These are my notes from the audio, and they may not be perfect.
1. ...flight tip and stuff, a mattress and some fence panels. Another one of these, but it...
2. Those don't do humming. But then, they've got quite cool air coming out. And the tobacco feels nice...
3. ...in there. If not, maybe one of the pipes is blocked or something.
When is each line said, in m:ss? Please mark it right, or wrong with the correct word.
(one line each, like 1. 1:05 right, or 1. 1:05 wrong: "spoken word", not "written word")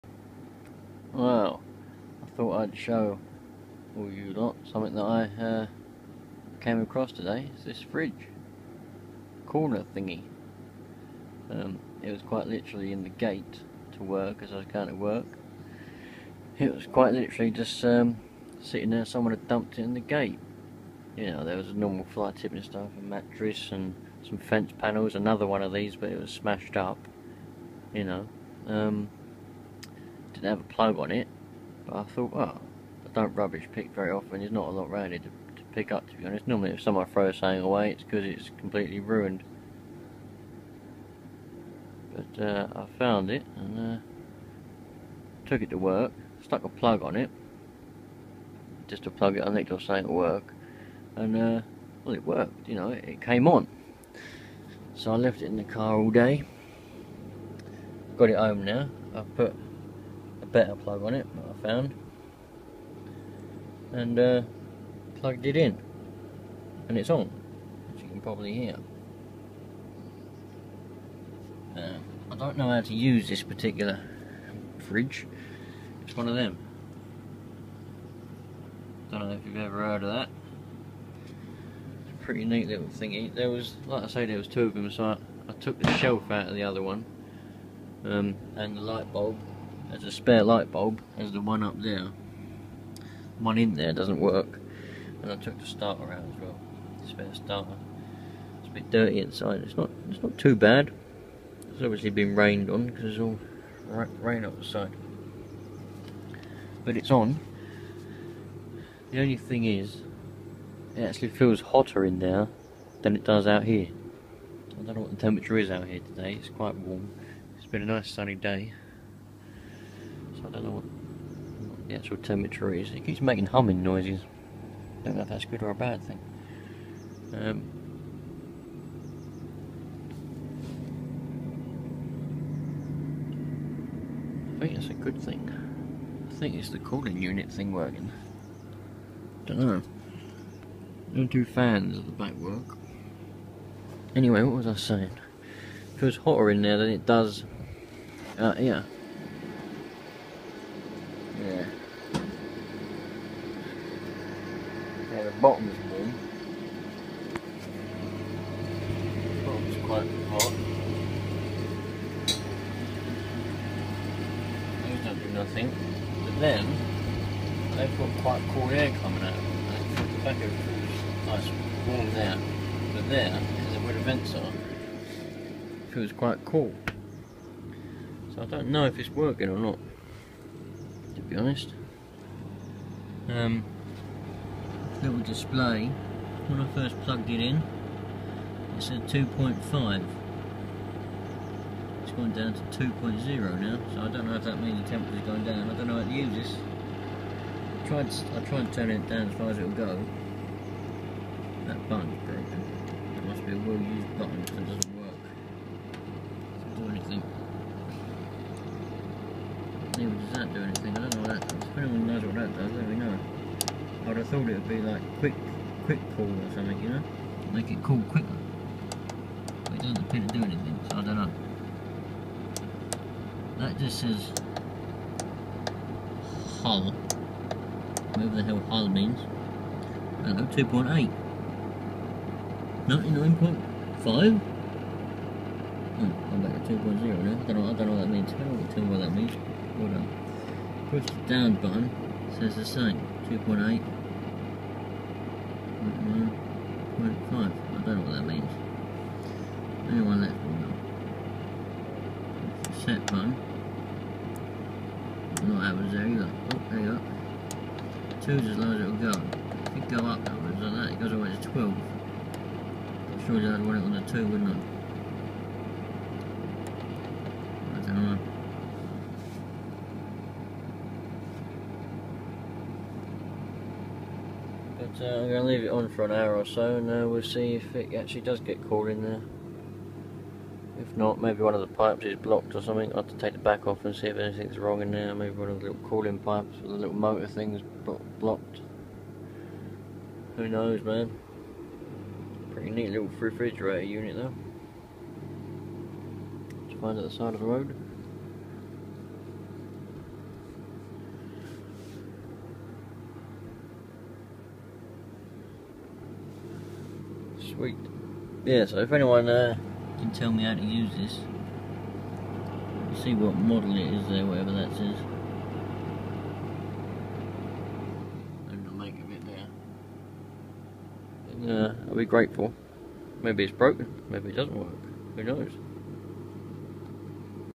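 1. 0:22 right
2. 2:44 wrong: "nothing", not "humming"
3. 4:38 right.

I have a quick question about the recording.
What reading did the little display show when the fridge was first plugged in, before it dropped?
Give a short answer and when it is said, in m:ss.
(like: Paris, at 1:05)
2.5, at 3:09.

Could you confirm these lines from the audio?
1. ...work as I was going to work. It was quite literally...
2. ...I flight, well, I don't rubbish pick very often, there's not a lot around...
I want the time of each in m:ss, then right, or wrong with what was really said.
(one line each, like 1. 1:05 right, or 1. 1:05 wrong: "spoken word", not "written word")
1. 0:14 right
2. 0:31 wrong: "thought", not "flight".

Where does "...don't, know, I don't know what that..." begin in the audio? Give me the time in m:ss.
3:57.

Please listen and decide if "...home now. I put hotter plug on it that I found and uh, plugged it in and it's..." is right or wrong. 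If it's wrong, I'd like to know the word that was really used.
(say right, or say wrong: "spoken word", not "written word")
wrong: "better", not "hotter".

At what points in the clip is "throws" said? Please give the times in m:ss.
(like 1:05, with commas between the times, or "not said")
0:37.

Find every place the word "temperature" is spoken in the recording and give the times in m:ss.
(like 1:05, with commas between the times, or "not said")
1:55, 2:02, 3:14.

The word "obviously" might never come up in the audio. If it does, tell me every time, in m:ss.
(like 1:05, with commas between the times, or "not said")
1:41.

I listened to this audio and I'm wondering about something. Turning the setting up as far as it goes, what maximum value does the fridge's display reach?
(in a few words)
12.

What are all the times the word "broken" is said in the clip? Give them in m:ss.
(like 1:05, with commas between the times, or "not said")
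3:22, 5:23.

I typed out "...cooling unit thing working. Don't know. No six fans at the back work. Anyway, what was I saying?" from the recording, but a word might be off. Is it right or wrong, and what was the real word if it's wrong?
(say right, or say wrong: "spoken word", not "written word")
wrong: "two", not "six".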